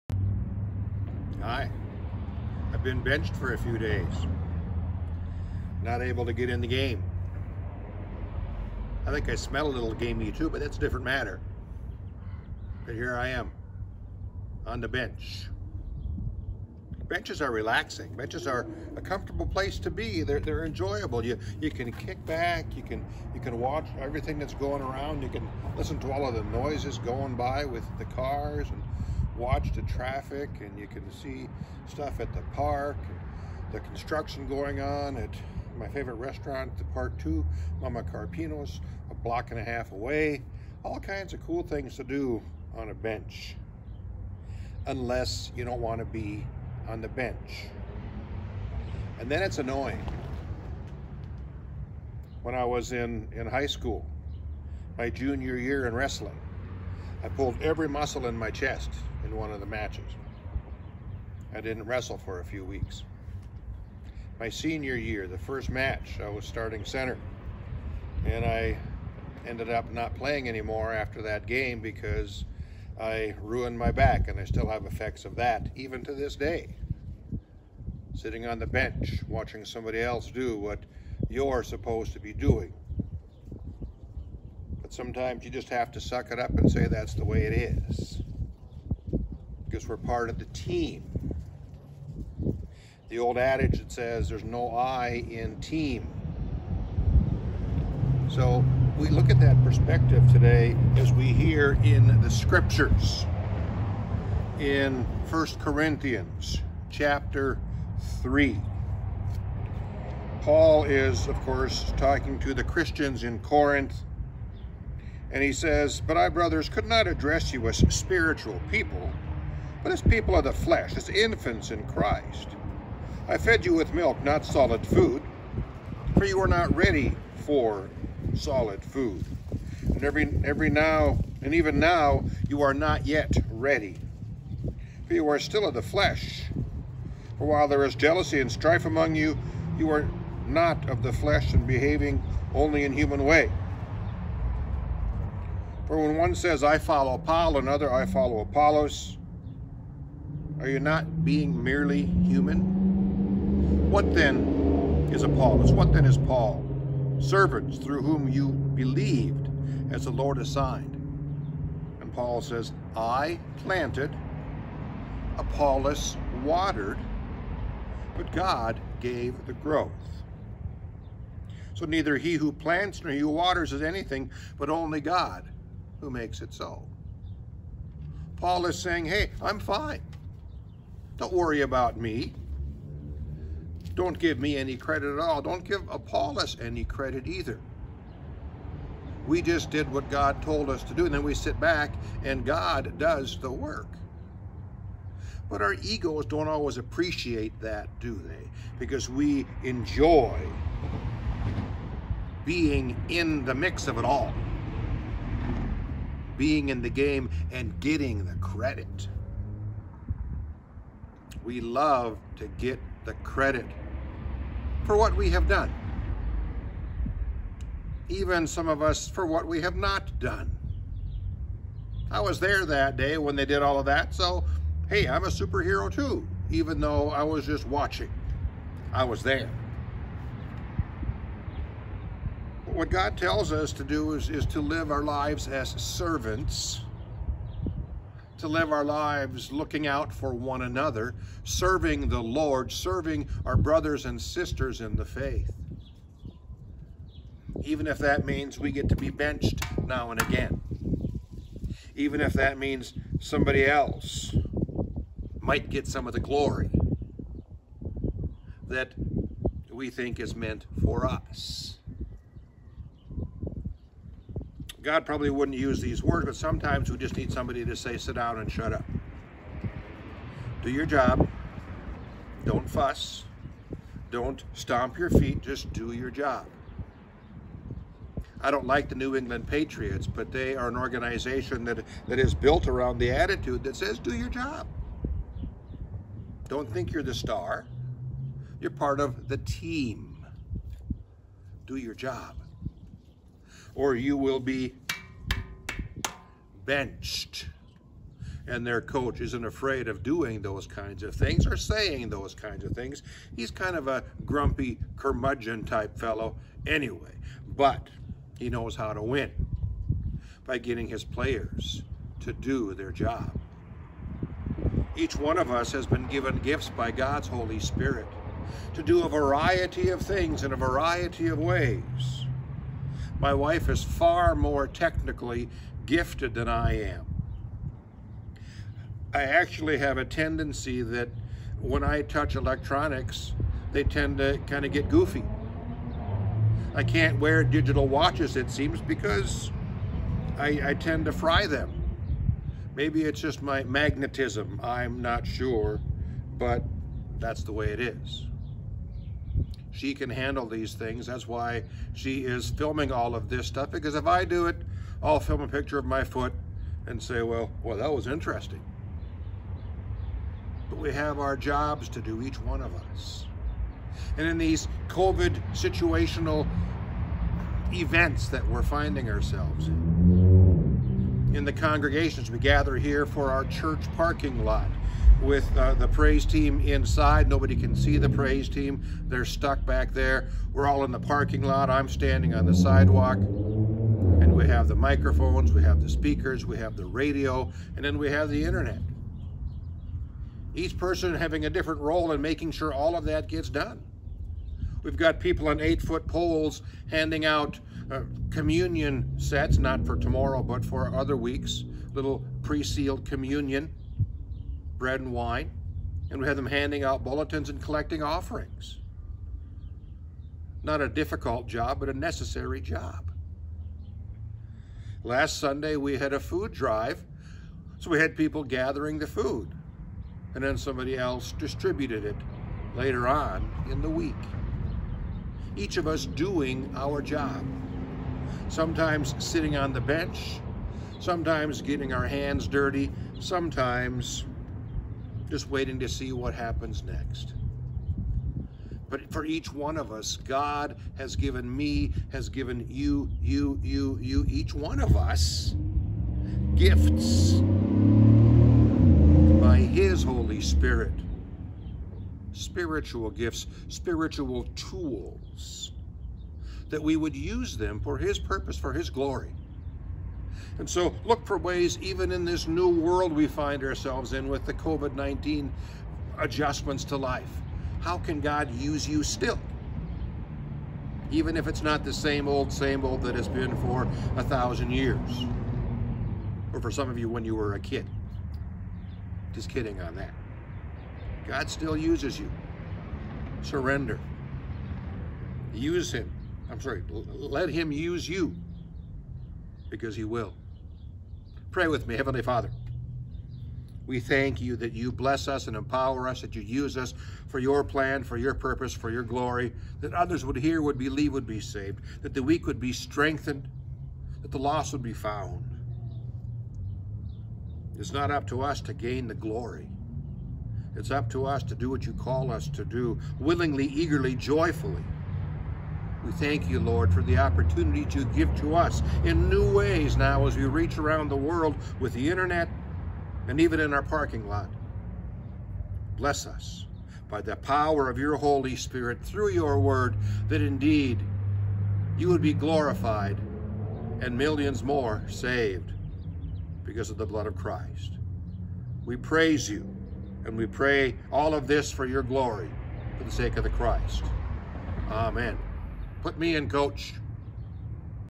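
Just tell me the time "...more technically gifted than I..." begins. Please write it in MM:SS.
05:24.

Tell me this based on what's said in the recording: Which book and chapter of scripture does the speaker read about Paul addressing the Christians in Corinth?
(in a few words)
1 Corinthians 3.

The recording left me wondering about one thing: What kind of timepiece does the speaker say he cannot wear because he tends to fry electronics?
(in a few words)
Digital watches.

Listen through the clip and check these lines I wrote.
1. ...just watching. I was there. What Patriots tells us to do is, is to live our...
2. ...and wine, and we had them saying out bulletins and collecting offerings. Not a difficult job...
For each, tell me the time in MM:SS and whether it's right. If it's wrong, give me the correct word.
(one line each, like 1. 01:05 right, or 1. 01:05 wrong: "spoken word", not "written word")
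1. 03:47 wrong: "God", not "Patriots"
2. 06:44 wrong: "handing", not "saying".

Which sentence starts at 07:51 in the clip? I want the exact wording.
Even if it's not the same old, same old that has been for a thousand years.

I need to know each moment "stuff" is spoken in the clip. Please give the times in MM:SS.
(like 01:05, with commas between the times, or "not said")
00:31, 05:53.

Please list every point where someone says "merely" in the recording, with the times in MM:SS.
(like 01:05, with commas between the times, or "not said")
02:31.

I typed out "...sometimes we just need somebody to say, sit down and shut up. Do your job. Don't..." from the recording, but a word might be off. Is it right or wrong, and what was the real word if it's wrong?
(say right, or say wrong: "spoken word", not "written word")
right.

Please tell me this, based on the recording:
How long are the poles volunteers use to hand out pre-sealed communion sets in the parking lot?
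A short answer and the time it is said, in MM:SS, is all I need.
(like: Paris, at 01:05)
8 feet, at 06:35.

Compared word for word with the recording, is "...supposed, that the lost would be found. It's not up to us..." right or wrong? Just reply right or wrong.
wrong.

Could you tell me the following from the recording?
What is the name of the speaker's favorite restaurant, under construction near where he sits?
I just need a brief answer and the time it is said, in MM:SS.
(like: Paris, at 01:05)
Mama Carpino's, at 00:37.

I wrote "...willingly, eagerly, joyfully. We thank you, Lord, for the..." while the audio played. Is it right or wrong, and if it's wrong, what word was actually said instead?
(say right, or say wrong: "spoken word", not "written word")
right.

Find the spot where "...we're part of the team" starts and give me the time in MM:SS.
01:29.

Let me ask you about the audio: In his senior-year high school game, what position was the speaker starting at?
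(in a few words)
Center.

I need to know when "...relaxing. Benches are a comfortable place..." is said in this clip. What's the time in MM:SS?
00:17.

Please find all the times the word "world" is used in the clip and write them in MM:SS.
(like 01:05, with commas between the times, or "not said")
07:42, 08:41.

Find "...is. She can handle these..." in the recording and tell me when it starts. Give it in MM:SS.
05:47.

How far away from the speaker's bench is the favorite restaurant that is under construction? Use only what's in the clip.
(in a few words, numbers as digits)
A block and a half.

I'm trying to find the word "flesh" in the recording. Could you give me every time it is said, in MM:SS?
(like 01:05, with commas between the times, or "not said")
02:00, 02:15, 02:21.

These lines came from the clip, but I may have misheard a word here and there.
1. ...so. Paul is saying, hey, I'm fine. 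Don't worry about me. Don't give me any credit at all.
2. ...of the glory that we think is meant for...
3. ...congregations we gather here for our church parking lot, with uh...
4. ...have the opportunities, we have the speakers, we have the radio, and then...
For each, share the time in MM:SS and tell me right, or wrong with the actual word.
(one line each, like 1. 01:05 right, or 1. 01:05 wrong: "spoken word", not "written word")
1. 02:56 right
2. 04:16 right
3. 06:11 right
4. 06:24 wrong: "microphones", not "opportunities".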